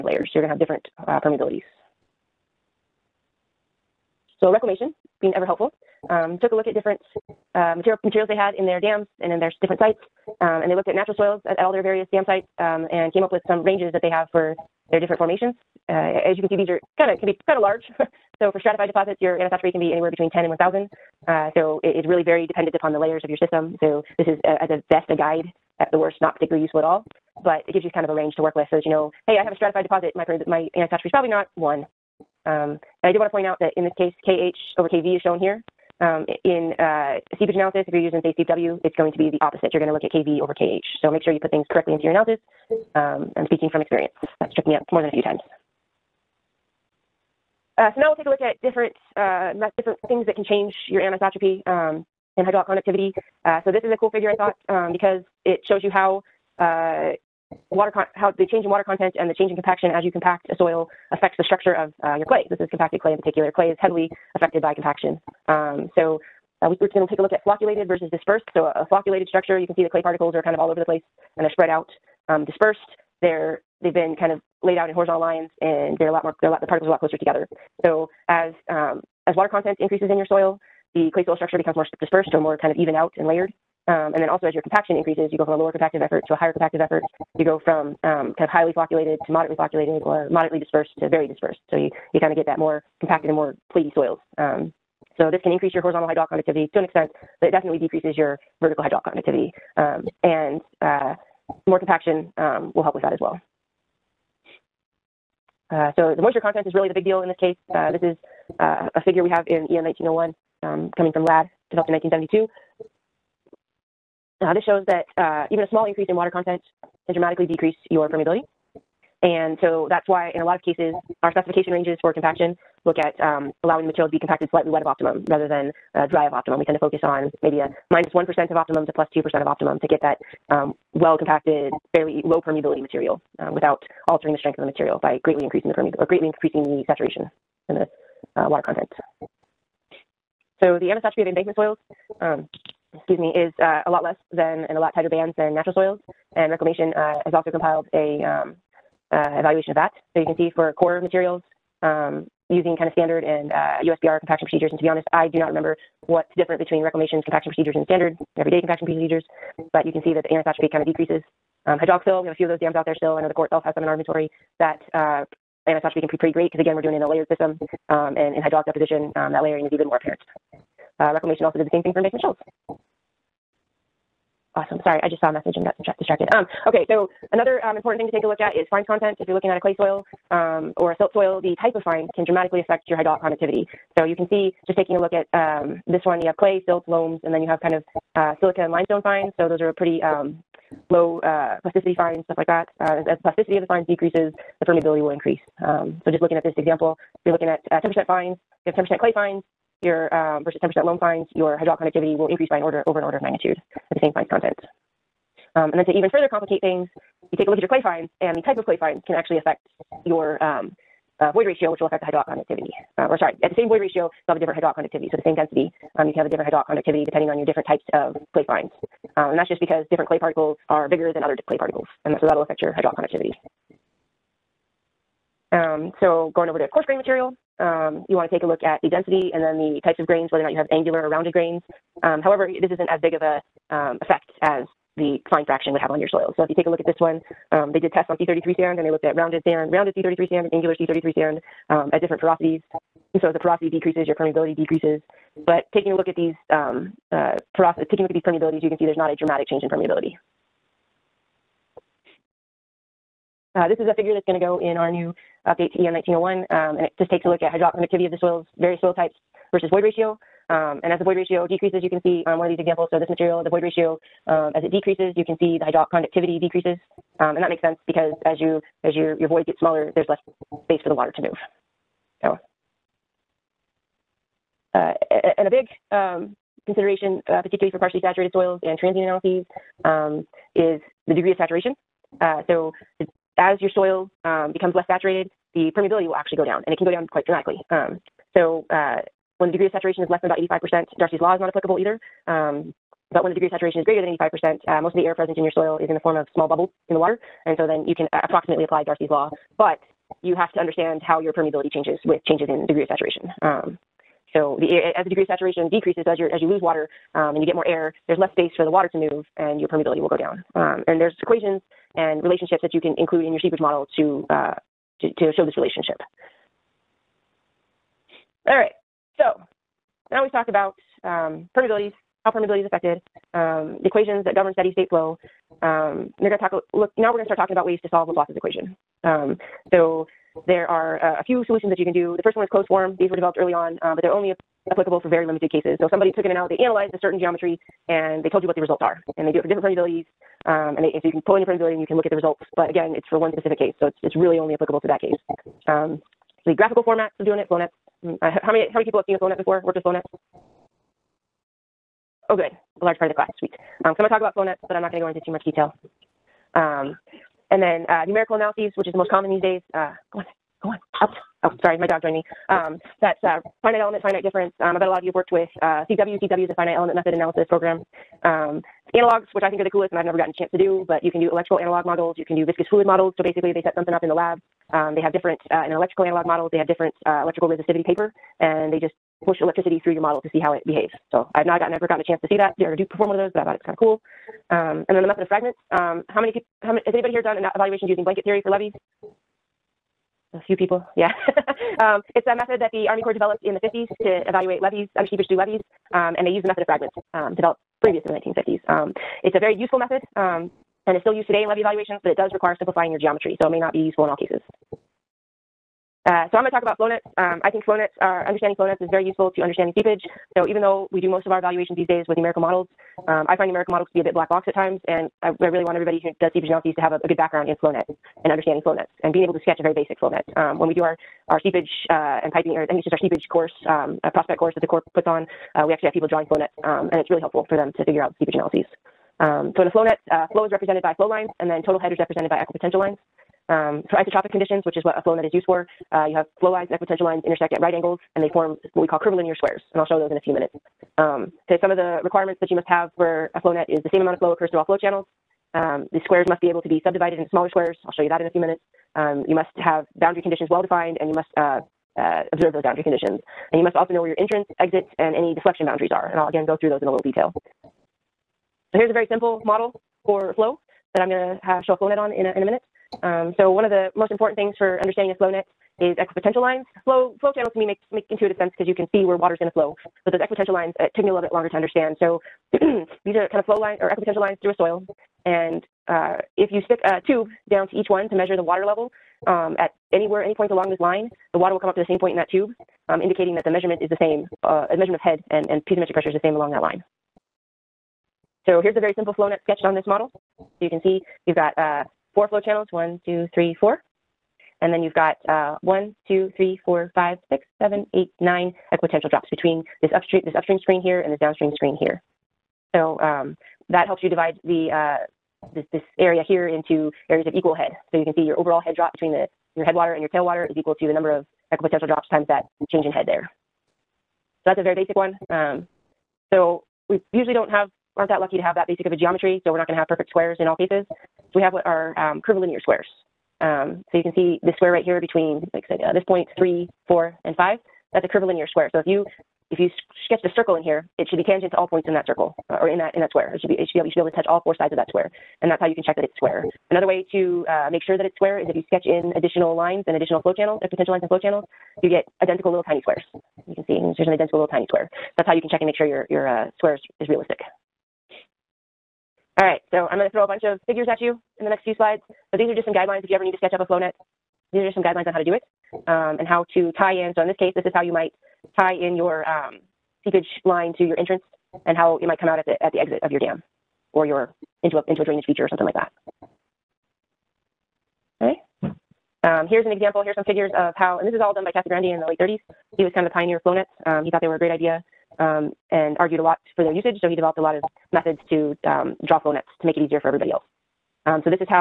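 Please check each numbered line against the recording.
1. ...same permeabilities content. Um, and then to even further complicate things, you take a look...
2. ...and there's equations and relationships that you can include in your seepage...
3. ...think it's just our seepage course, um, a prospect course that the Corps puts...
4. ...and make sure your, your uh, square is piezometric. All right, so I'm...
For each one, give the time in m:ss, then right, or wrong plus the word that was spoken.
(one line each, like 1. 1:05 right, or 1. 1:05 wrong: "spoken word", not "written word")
1. 3:24 wrong: "fines", not "permeabilities"
2. 5:10 right
3. 7:02 right
4. 9:05 wrong: "realistic", not "piezometric".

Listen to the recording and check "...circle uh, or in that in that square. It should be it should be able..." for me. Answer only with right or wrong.
right.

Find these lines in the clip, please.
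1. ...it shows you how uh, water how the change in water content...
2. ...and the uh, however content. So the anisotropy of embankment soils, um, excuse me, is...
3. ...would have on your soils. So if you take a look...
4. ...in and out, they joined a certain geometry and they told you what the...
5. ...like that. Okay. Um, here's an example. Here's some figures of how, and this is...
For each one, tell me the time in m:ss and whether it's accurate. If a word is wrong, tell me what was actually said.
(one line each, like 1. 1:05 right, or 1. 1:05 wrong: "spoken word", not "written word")
1. 0:55 right
2. 2:17 wrong: "water", not "however"
3. 3:55 right
4. 5:36 wrong: "analyzed", not "joined"
5. 9:25 right.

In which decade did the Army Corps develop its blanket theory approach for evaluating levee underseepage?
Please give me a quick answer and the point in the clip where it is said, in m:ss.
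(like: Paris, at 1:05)
the 1950s, at 6:33.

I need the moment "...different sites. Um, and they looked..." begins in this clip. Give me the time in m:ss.
0:09.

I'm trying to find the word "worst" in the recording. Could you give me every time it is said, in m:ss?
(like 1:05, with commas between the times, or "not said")
0:25.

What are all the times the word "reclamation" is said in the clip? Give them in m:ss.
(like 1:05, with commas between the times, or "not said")
0:04, 2:26, 2:36, 2:51.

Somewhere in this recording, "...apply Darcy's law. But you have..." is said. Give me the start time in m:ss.
4:58.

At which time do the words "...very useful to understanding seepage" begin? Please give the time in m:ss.
6:48.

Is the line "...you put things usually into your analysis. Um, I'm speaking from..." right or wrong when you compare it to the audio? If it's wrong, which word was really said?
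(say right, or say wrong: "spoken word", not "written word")
wrong: "correctly", not "usually".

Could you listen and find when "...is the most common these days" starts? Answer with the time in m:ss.
5:58.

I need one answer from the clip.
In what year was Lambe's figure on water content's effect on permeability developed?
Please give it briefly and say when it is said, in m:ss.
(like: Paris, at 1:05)
1972, at 1:51.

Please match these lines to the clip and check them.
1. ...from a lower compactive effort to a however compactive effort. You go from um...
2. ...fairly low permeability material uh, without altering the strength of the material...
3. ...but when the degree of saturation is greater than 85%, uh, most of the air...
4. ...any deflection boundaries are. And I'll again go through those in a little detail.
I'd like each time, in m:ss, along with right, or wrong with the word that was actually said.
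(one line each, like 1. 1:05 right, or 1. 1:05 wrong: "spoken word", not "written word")
1. 1:25 wrong: "higher", not "however"
2. 2:11 right
3. 4:53 right
4. 7:35 right.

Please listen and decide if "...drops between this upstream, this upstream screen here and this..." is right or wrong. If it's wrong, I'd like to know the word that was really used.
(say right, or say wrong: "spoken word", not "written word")
right.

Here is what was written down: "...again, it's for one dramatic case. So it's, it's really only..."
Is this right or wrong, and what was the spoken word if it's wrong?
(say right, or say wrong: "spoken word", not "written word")
wrong: "specific", not "dramatic".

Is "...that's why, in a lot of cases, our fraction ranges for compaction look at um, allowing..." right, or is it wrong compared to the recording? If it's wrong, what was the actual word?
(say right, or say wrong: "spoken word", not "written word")
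wrong: "specification", not "fraction".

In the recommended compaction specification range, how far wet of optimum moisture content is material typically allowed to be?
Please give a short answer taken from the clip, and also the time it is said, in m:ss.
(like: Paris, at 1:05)
plus 2%, at 2:08.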